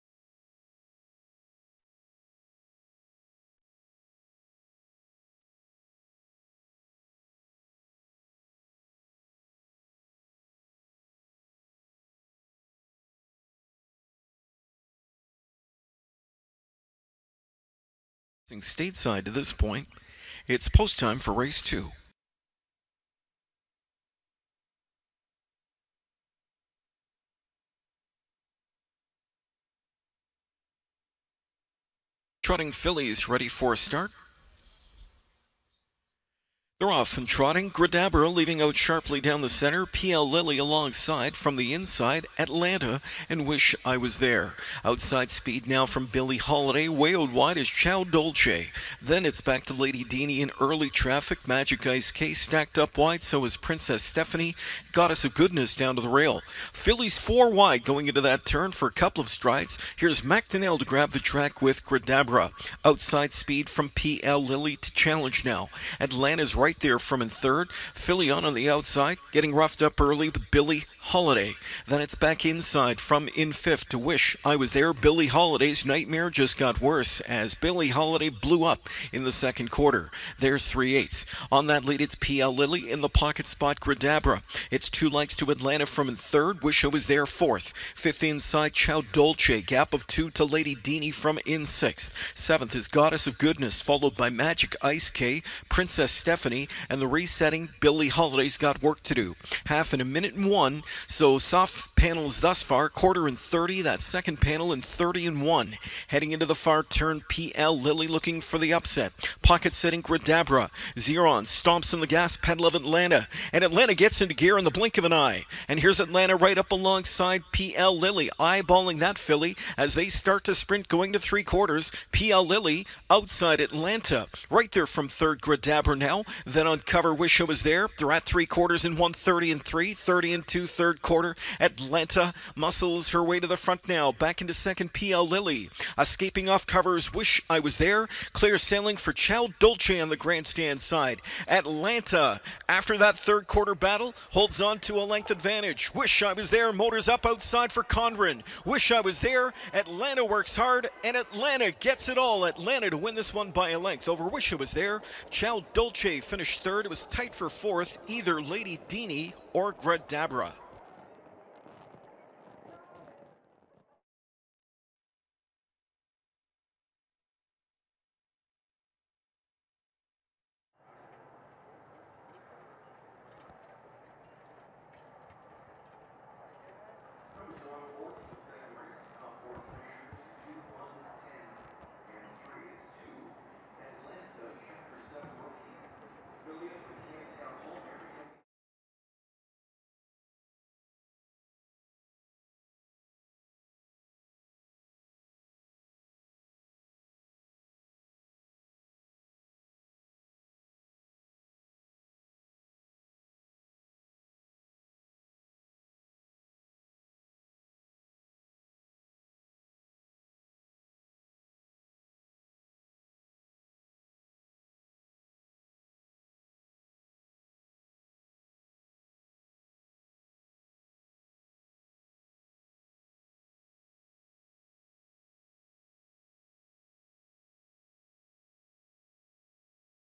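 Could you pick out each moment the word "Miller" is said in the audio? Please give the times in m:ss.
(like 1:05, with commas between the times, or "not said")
not said.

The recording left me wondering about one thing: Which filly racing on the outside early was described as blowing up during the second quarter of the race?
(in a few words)
Billie Holiday.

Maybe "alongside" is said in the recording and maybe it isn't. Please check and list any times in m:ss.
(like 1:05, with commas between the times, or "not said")
0:40, 1:56.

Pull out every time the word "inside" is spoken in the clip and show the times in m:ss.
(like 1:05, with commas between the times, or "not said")
0:41, 1:12, 1:28.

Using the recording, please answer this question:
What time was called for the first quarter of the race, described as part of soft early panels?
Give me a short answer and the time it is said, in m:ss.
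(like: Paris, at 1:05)
30, at 1:42.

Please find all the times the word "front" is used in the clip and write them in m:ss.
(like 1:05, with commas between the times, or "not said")
2:13.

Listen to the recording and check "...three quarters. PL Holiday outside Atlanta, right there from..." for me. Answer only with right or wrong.
wrong.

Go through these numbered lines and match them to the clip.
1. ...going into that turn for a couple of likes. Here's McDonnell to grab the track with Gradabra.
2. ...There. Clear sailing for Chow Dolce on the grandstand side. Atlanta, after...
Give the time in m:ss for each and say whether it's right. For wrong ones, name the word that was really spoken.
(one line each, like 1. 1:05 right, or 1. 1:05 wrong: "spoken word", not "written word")
1. 0:57 wrong: "strides", not "likes"
2. 2:17 right.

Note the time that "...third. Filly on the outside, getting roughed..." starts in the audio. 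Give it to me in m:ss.
1:07.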